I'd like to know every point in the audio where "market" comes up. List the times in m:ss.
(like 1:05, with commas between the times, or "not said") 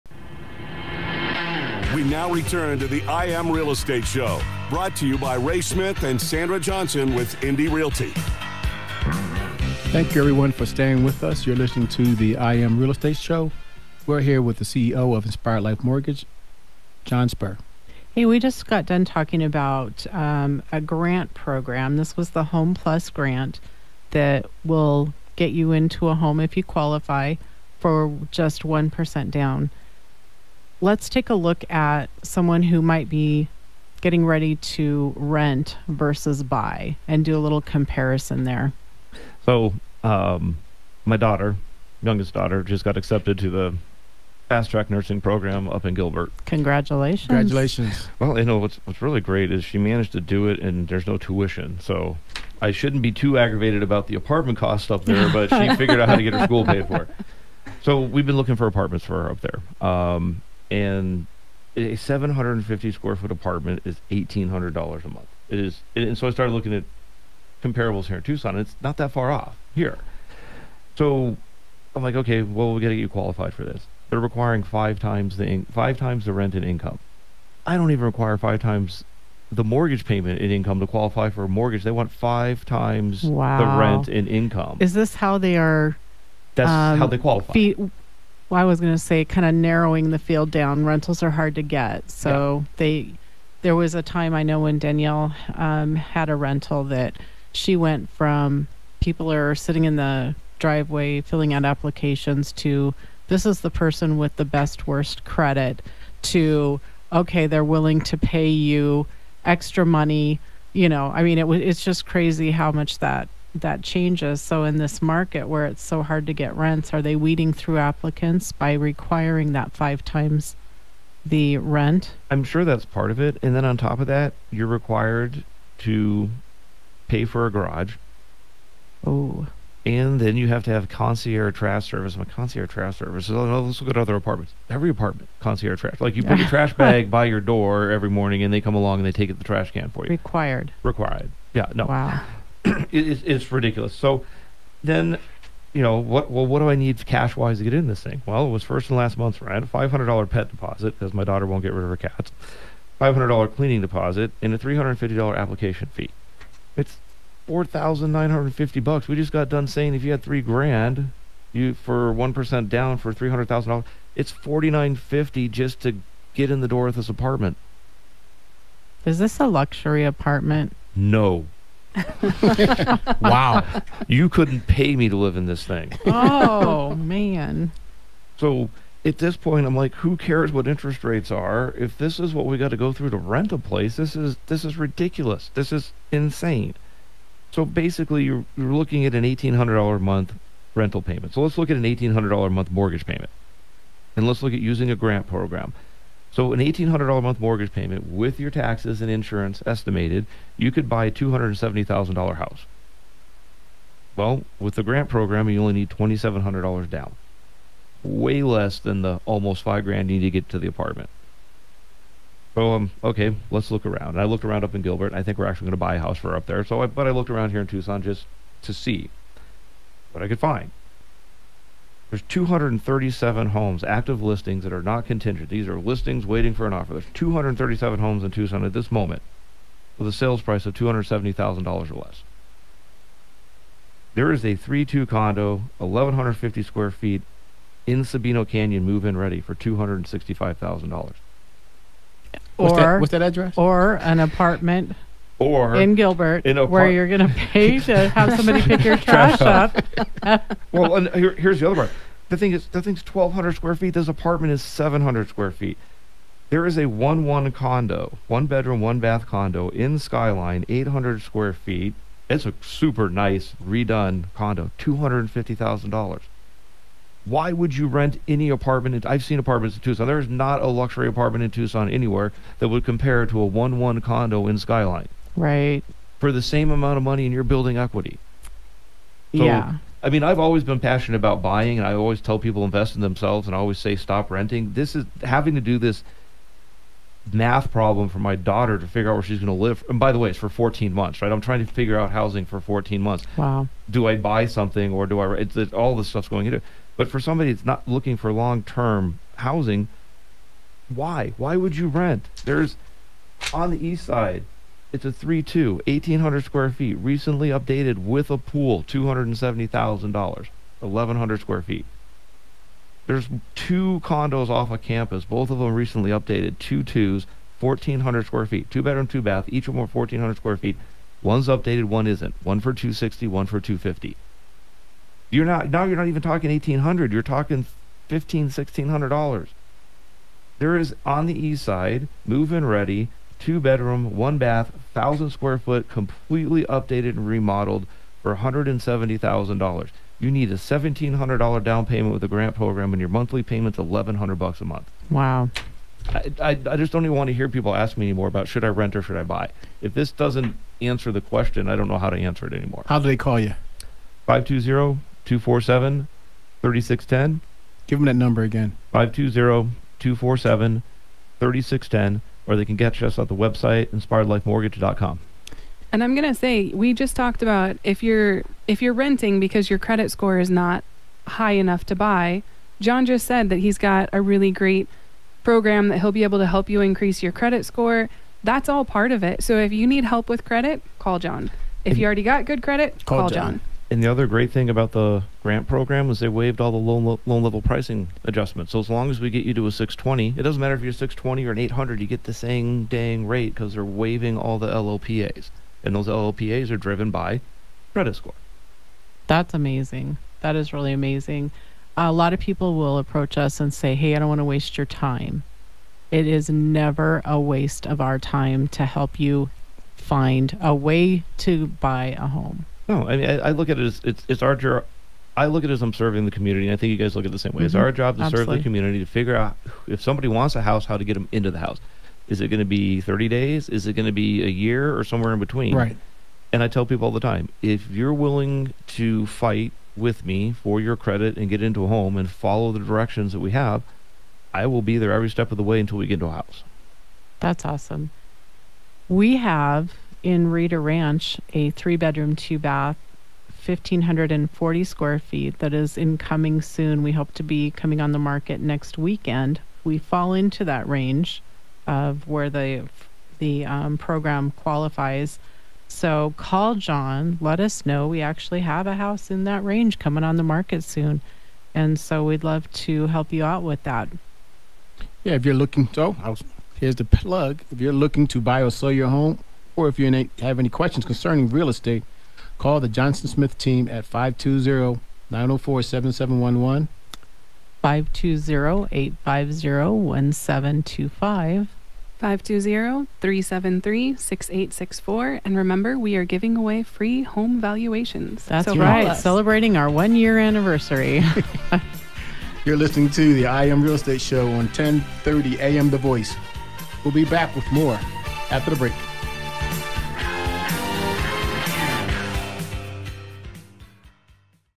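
1:55, 7:28, 7:40.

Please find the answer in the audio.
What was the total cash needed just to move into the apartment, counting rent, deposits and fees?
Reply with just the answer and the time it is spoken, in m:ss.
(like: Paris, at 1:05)
$4,950, at 2:37.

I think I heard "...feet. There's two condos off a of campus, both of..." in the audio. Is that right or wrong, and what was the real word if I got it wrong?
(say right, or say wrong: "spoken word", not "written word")
right.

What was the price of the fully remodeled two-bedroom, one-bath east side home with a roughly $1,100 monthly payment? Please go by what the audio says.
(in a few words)
$170,000.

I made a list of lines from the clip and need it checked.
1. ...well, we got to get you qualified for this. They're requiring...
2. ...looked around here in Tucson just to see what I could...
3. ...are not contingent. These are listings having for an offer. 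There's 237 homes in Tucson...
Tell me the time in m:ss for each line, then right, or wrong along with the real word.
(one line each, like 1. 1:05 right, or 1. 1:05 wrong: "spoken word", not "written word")
1. 1:12 right
2. 3:37 right
3. 3:44 wrong: "waiting", not "having".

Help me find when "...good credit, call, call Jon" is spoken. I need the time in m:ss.
6:22.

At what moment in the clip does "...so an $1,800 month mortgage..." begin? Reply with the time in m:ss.
3:16.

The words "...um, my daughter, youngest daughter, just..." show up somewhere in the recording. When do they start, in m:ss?
0:40.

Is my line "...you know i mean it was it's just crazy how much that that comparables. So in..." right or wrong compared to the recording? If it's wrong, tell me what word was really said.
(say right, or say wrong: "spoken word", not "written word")
wrong: "changes", not "comparables".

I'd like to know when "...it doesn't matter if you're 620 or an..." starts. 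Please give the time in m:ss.
6:30.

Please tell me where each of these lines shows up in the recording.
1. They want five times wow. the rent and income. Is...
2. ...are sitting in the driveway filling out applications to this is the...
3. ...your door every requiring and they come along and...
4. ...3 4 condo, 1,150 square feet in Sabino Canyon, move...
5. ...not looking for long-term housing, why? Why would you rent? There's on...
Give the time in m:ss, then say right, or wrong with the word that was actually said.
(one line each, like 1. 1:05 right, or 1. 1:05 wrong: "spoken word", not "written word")
1. 1:21 right
2. 1:39 right
3. 2:17 wrong: "morning", not "requiring"
4. 3:54 wrong: "2", not "4"
5. 4:57 right.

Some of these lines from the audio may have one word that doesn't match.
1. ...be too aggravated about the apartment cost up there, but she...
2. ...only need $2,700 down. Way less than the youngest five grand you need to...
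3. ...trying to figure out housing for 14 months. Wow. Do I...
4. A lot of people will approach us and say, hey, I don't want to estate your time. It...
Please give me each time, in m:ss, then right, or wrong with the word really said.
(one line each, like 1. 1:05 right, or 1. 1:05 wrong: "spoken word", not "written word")
1. 0:53 right
2. 3:25 wrong: "almost", not "youngest"
3. 4:51 right
4. 6:41 wrong: "waste", not "estate".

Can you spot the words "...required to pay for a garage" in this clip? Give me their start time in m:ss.
2:04.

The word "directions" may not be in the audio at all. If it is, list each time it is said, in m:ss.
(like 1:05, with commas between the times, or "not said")
7:12.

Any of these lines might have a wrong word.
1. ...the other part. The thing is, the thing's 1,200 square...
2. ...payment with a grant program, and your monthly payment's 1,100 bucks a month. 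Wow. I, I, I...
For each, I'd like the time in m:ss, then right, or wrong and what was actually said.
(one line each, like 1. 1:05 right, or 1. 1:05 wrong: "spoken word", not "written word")
1. 4:11 right
2. 5:41 right.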